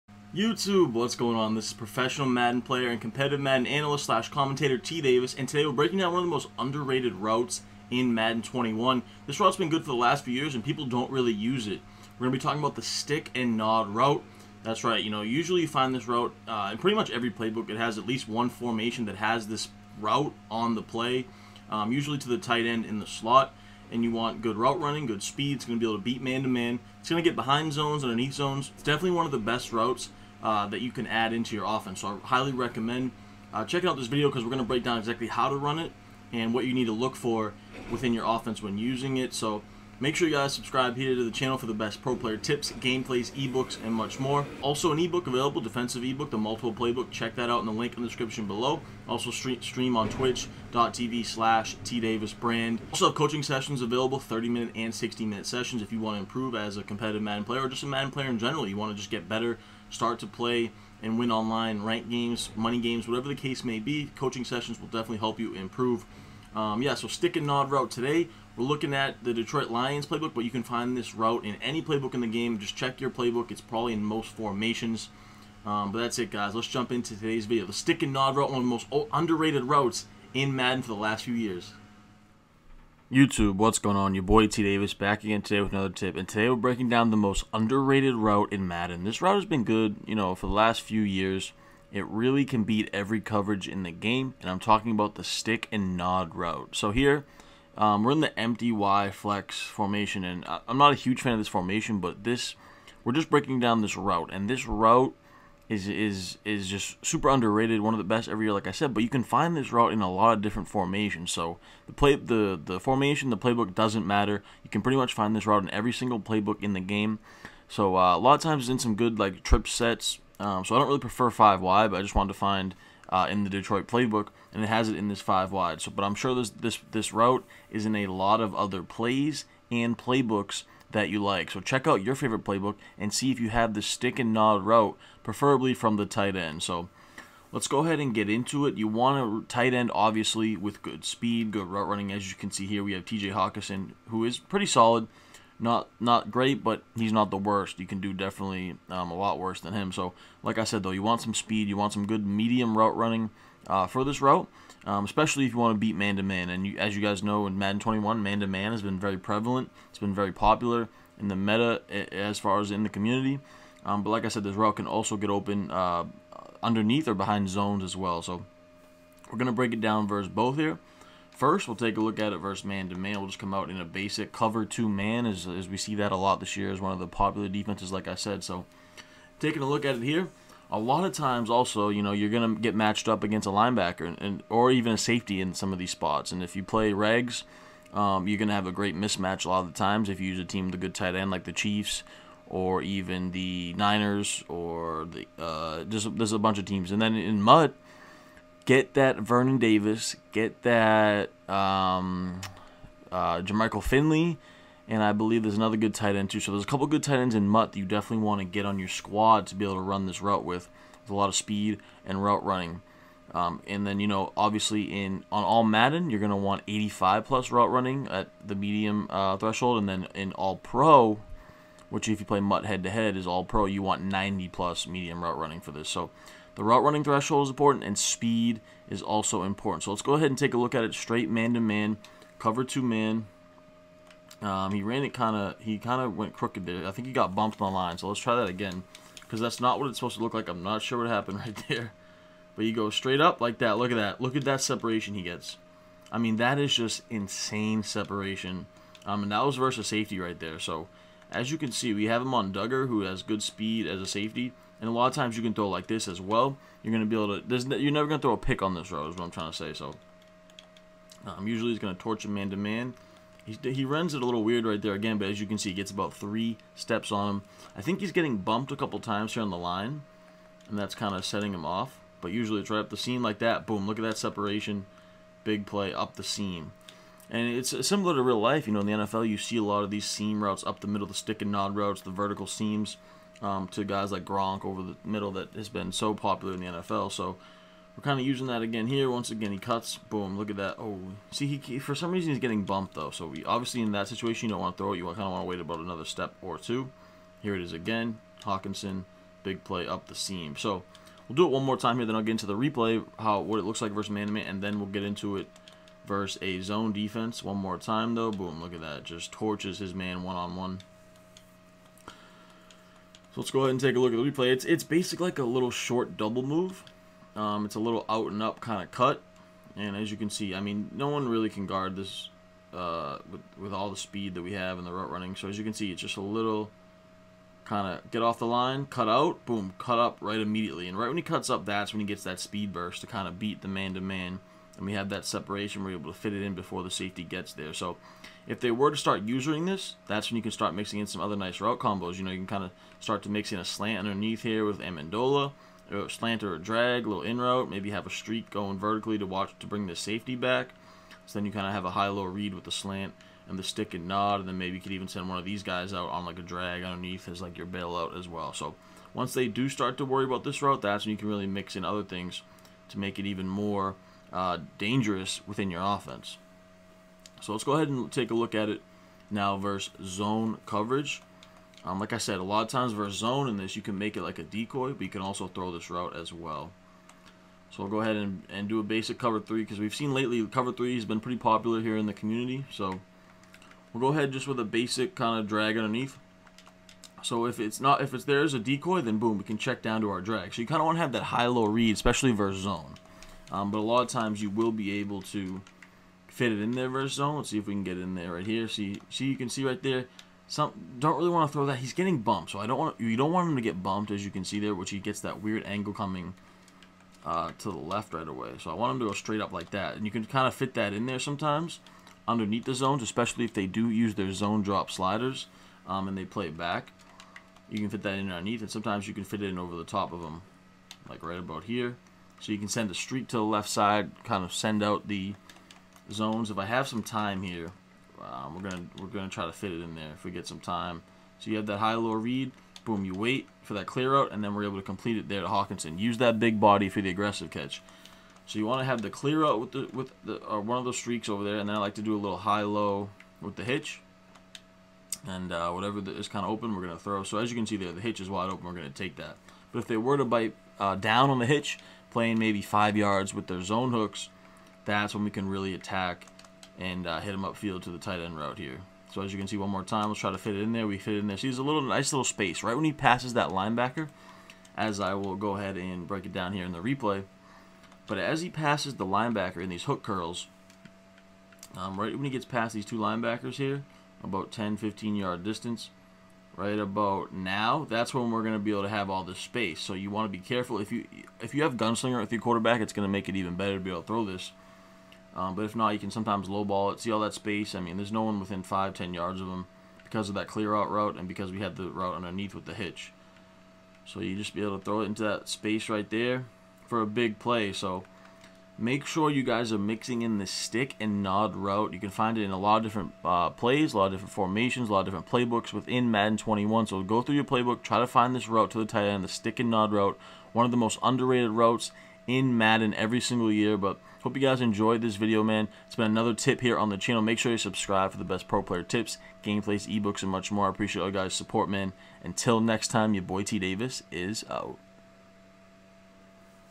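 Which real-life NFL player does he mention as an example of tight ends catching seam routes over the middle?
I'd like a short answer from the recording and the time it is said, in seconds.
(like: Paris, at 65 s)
Gronk, at 284 s.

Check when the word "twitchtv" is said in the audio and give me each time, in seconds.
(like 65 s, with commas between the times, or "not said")
50 s.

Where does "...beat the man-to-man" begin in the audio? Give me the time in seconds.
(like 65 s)
333 s.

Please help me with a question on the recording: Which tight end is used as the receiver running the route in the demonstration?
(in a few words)
TJ Hockenson.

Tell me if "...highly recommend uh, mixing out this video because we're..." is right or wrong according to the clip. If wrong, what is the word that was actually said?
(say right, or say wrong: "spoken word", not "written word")
wrong: "checking", not "mixing".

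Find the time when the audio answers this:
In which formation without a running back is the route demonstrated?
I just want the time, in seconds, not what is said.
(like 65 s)
98 s.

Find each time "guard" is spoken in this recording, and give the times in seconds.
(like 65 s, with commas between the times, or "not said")
321 s.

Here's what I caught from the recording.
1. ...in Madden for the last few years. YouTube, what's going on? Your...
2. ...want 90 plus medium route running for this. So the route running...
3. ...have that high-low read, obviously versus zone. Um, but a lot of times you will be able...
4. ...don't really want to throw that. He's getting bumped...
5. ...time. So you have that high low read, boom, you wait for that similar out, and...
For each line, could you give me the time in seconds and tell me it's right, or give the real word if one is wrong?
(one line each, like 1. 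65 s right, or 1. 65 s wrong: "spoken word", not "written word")
1. 80 s right
2. 223 s right
3. 391 s wrong: "especially", not "obviously"
4. 400 s right
5. 430 s wrong: "clear", not "similar".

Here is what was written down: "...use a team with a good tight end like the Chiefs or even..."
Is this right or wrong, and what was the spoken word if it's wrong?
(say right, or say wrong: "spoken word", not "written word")
right.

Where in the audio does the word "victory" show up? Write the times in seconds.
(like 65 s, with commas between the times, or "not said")
not said.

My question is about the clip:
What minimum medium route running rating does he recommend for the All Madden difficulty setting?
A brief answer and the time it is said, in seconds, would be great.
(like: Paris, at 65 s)
85, at 216 s.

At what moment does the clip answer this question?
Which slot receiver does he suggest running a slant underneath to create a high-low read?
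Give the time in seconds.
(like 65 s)
344 s.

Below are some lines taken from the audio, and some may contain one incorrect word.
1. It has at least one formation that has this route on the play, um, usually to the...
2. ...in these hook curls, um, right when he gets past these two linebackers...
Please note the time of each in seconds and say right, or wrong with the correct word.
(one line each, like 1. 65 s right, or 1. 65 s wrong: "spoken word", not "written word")
1. 17 s right
2. 469 s right.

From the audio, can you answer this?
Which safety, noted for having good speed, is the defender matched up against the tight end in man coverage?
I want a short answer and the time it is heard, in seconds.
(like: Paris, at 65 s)
Dugger, at 252 s.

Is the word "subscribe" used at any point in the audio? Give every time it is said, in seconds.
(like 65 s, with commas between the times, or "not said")
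40 s, 517 s.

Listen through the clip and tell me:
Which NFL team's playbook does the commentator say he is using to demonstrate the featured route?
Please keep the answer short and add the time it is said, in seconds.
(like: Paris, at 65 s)
Detroit Lions, at 69 s.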